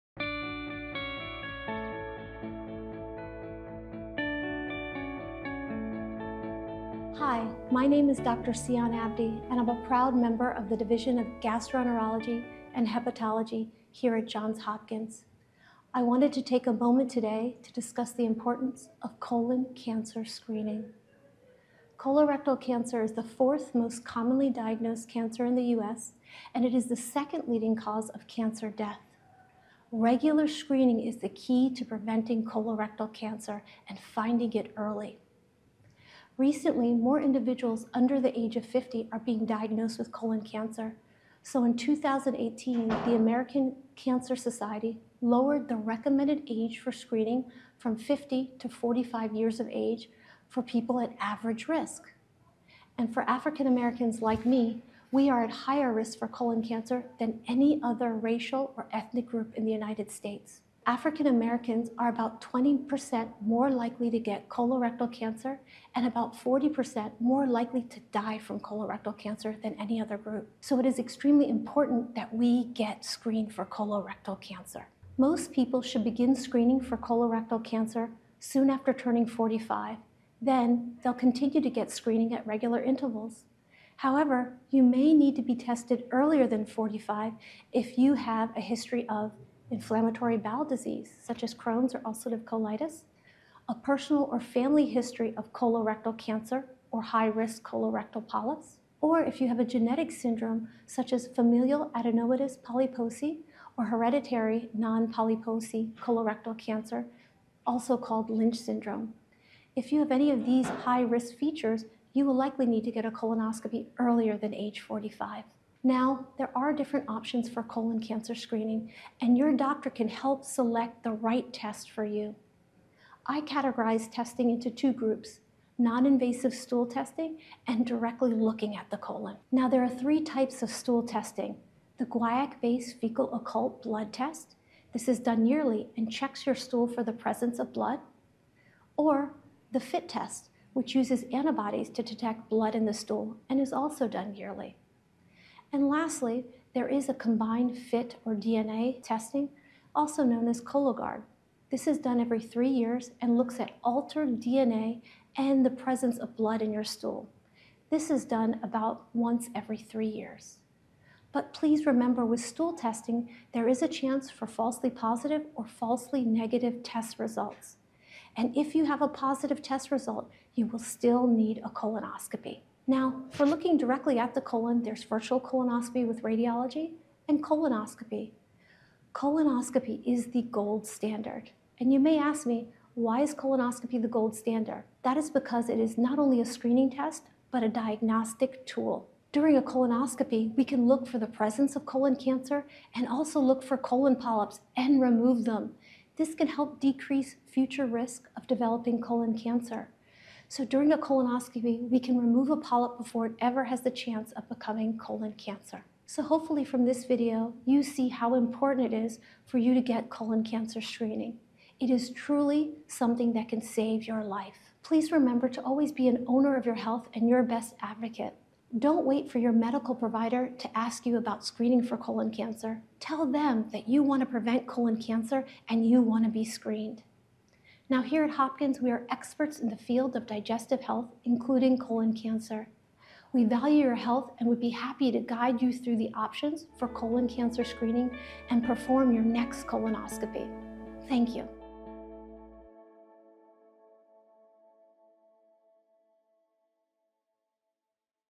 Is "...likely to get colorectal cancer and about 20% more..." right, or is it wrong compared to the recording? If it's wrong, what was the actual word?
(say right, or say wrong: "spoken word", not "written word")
wrong: "40", not "20".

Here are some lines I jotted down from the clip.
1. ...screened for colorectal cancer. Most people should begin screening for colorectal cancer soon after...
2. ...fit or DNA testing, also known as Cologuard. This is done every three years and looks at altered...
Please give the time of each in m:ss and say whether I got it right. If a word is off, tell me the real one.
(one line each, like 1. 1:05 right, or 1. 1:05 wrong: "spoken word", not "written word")
1. 1:13 right
2. 2:27 right.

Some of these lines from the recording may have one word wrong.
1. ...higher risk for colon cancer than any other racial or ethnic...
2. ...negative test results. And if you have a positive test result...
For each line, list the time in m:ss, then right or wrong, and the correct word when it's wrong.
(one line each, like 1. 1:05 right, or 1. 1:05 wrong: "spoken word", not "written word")
1. 0:55 right
2. 2:46 right.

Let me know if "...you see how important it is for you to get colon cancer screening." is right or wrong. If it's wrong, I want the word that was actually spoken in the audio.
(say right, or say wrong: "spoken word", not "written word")
right.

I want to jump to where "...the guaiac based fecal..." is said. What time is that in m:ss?
2:11.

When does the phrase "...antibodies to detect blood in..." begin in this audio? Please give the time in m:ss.
2:21.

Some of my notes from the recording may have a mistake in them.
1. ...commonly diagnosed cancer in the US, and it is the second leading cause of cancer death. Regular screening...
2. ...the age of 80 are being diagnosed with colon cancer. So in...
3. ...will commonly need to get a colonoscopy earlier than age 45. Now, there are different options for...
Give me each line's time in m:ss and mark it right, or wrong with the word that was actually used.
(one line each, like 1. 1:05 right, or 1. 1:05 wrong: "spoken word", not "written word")
1. 0:24 right
2. 0:38 wrong: "50", not "80"
3. 1:52 wrong: "likely", not "commonly".